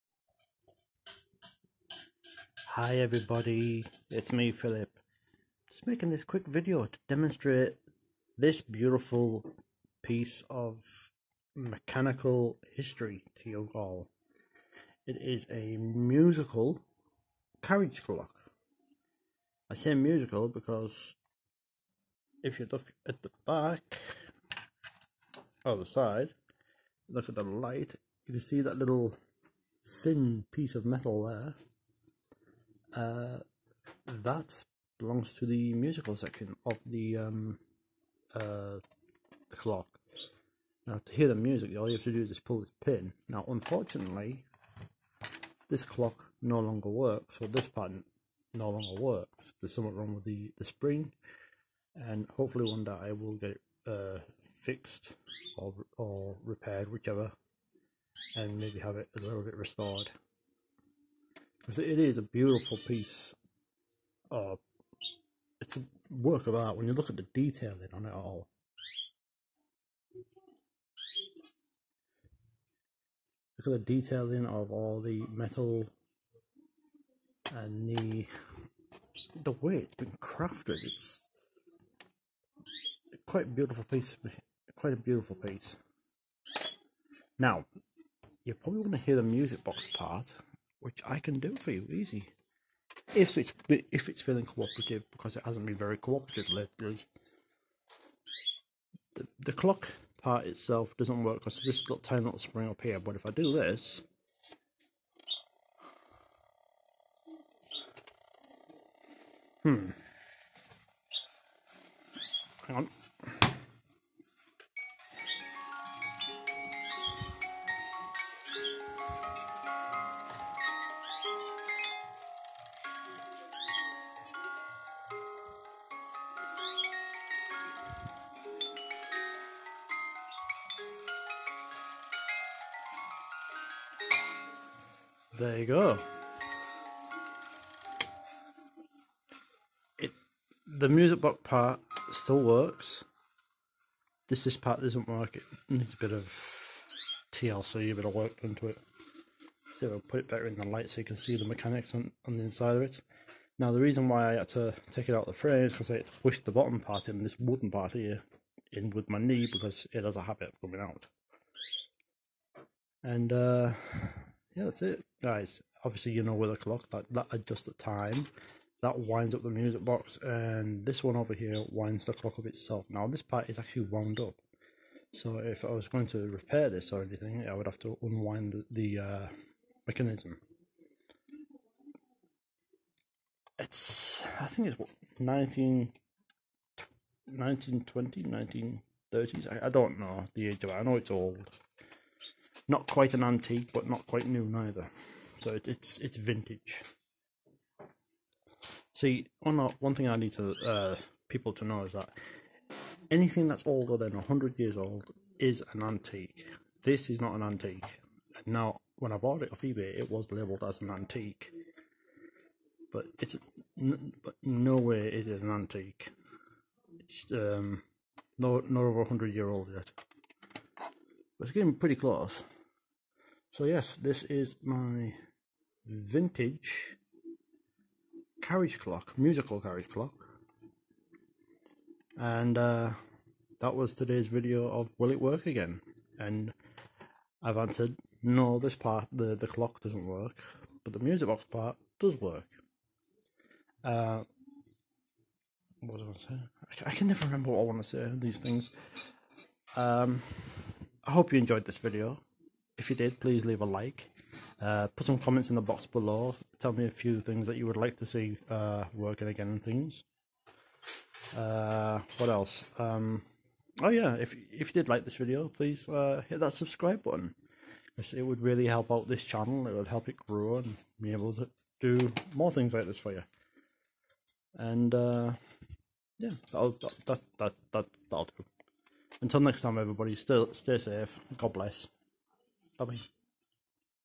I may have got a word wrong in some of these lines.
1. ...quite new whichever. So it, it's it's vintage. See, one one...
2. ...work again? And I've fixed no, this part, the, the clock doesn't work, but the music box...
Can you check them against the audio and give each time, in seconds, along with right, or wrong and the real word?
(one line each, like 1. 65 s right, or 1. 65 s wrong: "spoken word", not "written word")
1. 194 s wrong: "neither", not "whichever"
2. 235 s wrong: "answered", not "fixed".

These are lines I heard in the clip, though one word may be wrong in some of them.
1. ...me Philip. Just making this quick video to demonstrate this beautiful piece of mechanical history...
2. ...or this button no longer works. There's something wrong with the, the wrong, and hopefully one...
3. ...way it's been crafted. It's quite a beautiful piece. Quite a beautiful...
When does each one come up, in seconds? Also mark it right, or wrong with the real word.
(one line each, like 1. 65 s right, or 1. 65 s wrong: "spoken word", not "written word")
1. 4 s right
2. 47 s wrong: "spring", not "wrong"
3. 79 s right.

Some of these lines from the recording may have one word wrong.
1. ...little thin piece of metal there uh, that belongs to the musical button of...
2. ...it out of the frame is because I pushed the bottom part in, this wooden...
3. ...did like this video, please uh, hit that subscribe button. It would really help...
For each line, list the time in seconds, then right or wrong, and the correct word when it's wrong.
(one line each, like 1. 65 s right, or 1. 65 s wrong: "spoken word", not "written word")
1. 28 s wrong: "section", not "button"
2. 155 s right
3. 264 s right.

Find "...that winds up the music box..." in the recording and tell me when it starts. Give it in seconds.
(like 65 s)
168 s.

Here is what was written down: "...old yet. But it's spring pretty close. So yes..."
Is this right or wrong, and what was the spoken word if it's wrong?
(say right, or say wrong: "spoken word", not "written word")
wrong: "getting", not "spring".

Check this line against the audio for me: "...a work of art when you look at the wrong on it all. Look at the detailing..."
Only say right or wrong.
wrong.